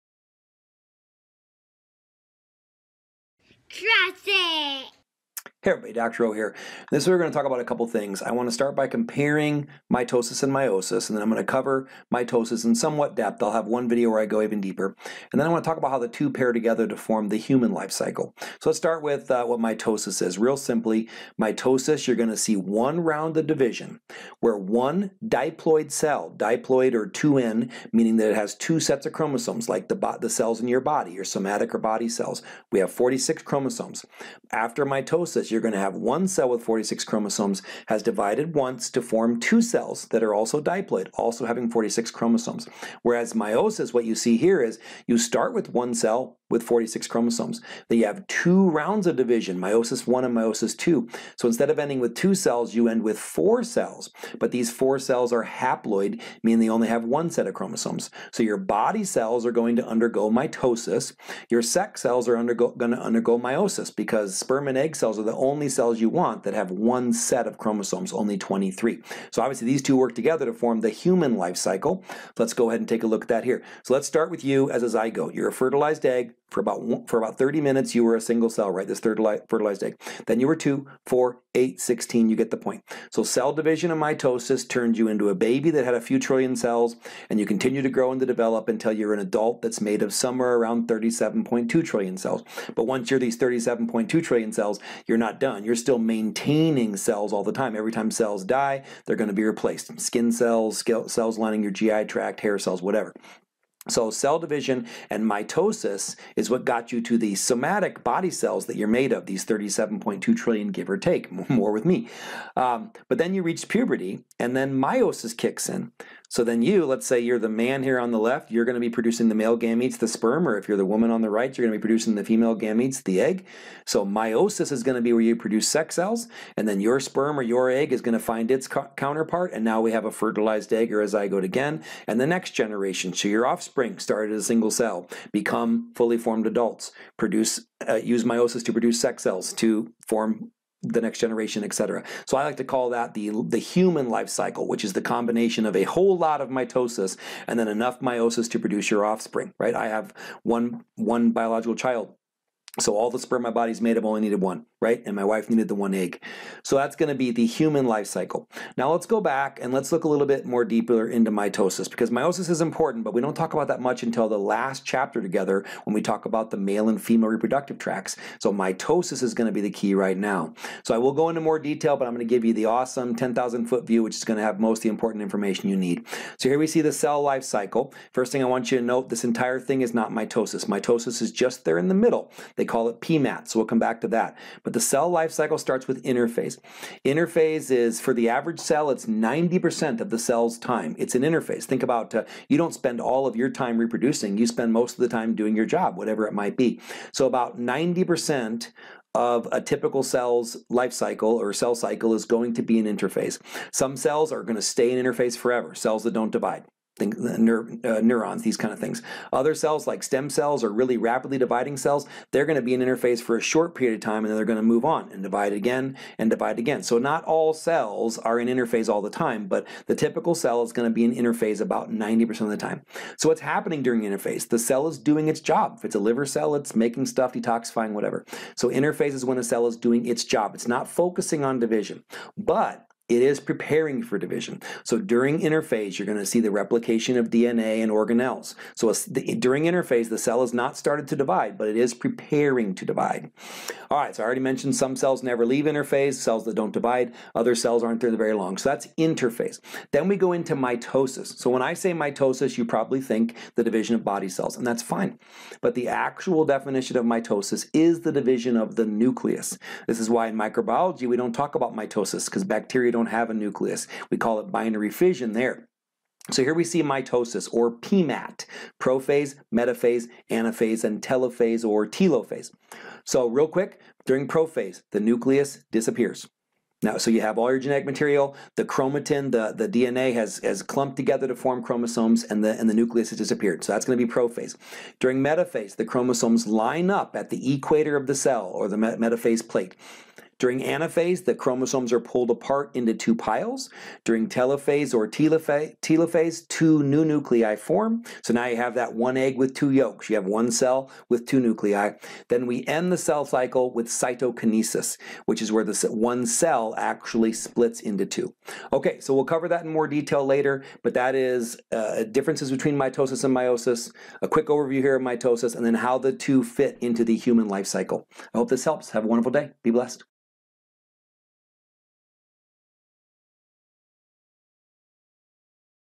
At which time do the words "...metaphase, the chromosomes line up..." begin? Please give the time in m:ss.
4:45.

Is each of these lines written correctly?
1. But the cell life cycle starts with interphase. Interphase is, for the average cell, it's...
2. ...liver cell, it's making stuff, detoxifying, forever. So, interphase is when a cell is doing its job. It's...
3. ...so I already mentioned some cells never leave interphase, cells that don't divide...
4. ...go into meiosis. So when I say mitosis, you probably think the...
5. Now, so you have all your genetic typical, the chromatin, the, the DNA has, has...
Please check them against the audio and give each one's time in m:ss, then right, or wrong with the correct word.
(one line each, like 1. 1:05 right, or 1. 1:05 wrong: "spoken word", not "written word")
1. 3:04 right
2. 3:45 wrong: "whatever", not "forever"
3. 4:04 right
4. 4:10 wrong: "mitosis", not "meiosis"
5. 4:36 wrong: "material", not "typical".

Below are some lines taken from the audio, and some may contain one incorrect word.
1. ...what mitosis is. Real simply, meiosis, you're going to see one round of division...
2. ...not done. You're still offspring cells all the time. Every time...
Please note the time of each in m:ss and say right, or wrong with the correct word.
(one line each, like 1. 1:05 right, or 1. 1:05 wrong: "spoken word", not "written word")
1. 0:19 wrong: "mitosis", not "meiosis"
2. 1:35 wrong: "maintaining", not "offspring".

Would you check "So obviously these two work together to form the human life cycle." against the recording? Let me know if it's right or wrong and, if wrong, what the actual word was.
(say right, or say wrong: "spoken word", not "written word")
right.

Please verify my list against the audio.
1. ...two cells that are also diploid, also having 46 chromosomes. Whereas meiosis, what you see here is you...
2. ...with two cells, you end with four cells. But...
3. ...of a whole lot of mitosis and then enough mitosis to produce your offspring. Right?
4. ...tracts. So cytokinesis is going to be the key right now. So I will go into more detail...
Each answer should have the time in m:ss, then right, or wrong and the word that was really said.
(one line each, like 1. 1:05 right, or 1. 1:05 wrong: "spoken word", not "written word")
1. 0:39 right
2. 0:52 right
3. 2:25 wrong: "meiosis", not "mitosis"
4. 2:47 wrong: "mitosis", not "cytokinesis".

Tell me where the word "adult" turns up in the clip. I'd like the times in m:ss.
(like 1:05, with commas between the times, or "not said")
1:29, 2:16.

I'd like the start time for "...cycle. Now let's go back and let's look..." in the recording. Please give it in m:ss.
2:38.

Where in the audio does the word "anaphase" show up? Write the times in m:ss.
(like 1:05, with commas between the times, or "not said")
4:30, 4:50.